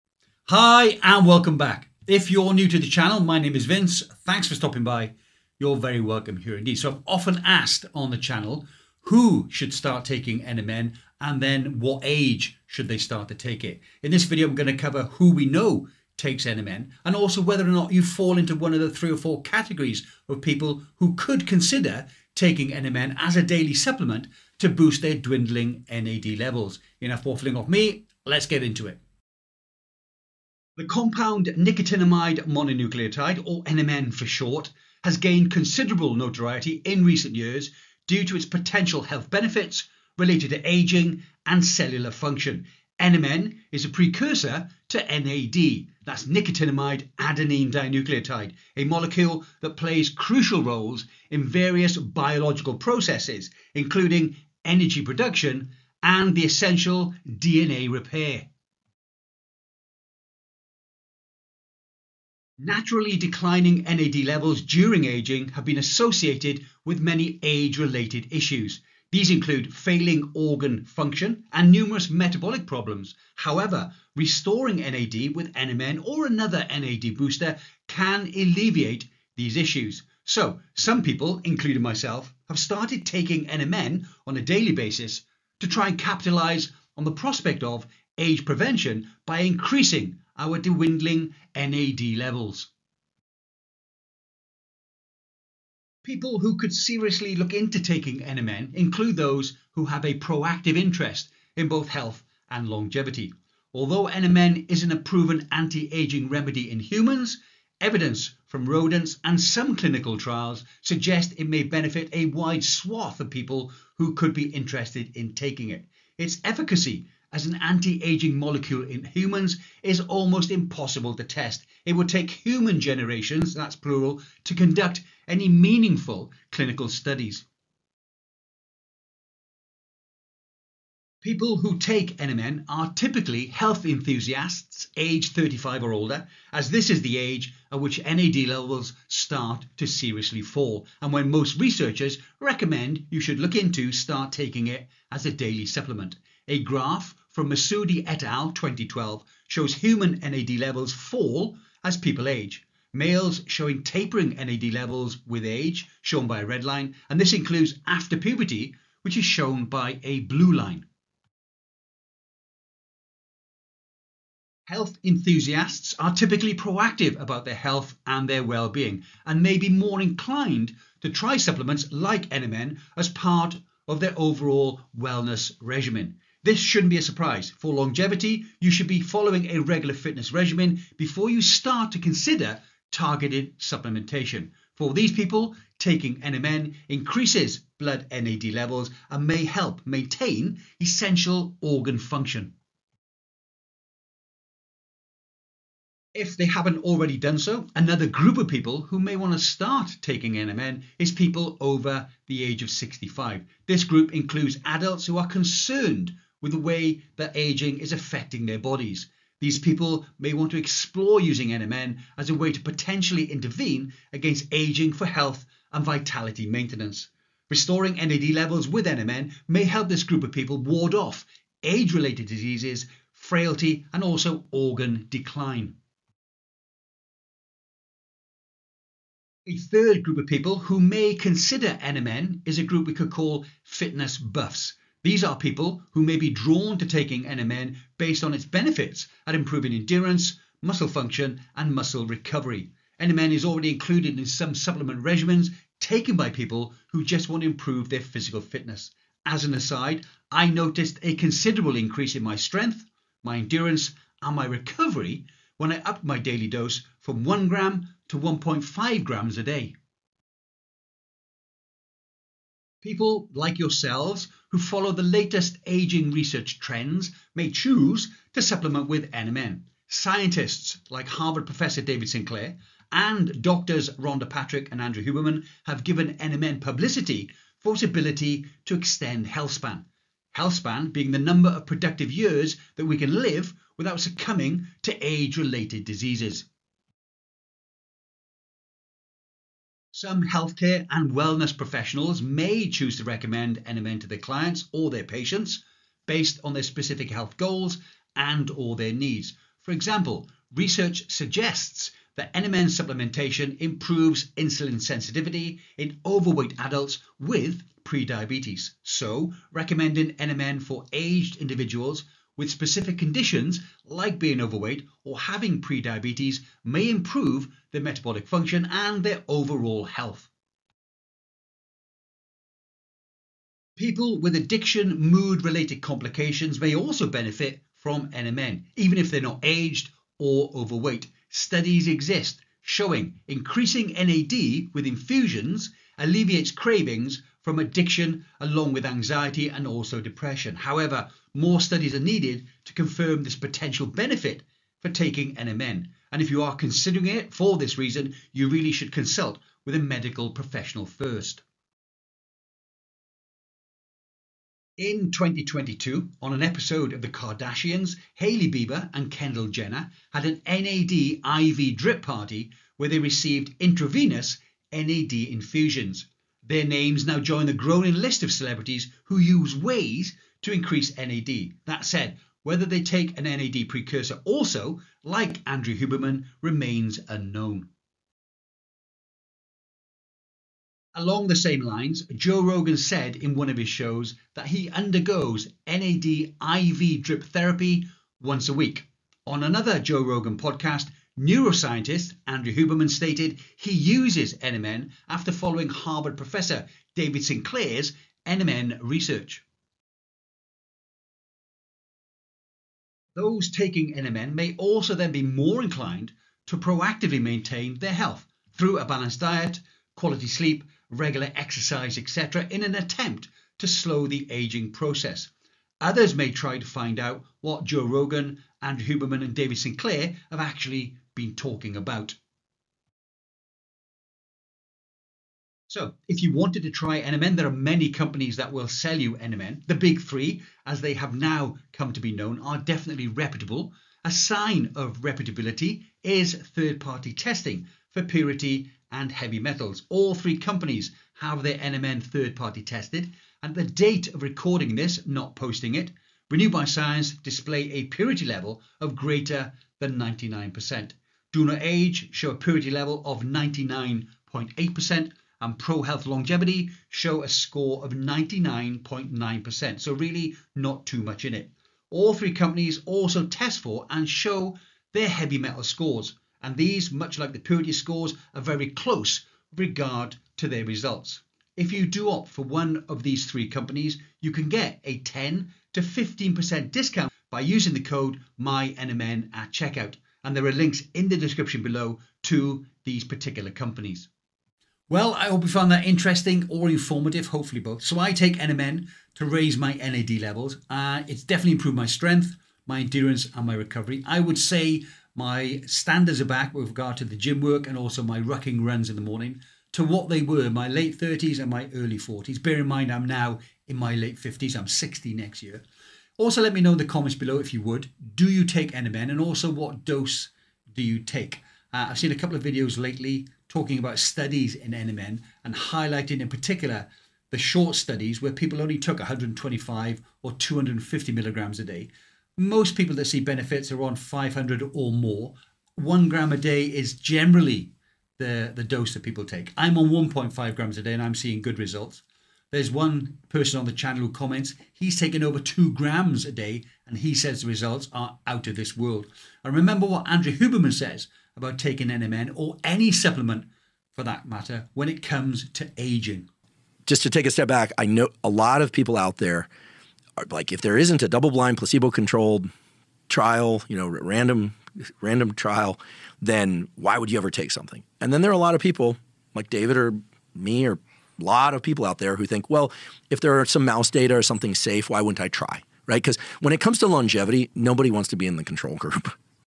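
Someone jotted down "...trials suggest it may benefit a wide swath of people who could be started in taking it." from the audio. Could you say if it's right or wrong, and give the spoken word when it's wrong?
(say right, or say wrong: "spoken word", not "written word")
wrong: "interested", not "started".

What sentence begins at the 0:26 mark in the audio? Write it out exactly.
Enough waffling off me, let's get into it.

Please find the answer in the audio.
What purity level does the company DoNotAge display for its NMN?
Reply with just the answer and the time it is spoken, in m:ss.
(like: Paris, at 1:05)
99.8%, at 7:33.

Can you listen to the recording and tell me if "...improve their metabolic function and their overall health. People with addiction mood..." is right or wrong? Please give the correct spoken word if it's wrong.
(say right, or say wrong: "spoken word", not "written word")
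right.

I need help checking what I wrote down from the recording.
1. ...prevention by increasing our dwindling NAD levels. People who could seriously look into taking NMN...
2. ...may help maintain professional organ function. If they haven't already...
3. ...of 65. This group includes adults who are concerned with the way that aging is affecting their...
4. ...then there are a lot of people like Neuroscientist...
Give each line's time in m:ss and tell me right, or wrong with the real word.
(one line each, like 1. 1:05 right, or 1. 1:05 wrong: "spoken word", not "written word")
1. 1:28 right
2. 3:09 wrong: "essential", not "professional"
3. 3:22 right
4. 9:18 wrong: "David", not "Neuroscientist".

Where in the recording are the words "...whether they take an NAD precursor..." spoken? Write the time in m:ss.
6:12.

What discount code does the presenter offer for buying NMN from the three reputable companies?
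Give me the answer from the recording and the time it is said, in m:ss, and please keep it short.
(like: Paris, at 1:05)
MyNMN, at 7:58.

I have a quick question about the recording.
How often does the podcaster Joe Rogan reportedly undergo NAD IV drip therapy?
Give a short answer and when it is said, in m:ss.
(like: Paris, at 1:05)
once a week, at 6:28.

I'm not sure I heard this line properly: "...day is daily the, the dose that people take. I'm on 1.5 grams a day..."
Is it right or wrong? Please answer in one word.
wrong.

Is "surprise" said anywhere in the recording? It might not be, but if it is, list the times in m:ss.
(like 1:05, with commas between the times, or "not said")
2:57.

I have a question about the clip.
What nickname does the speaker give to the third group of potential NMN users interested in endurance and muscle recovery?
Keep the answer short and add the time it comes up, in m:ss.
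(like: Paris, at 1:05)
fitness buffs, at 3:53.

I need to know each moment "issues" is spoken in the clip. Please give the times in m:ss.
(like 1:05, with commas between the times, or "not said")
1:08, 1:19.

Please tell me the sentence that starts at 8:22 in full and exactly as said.
Bear in mind, I'm now in my late 50s, I'm 60 next year.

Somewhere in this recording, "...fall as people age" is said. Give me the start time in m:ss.
2:30.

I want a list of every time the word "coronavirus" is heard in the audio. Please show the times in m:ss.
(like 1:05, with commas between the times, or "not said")
not said.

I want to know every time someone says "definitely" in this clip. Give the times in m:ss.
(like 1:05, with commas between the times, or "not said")
7:12, 8:11.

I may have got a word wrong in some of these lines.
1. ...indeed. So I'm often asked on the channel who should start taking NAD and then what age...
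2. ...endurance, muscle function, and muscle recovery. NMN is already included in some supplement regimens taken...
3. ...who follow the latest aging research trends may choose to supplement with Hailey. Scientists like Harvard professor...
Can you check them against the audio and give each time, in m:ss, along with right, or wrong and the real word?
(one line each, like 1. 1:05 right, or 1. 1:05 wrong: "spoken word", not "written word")
1. 0:06 wrong: "NMN", not "NAD"
2. 3:59 right
3. 4:24 wrong: "NMN", not "Hailey".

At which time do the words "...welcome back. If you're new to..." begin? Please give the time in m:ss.
0:01.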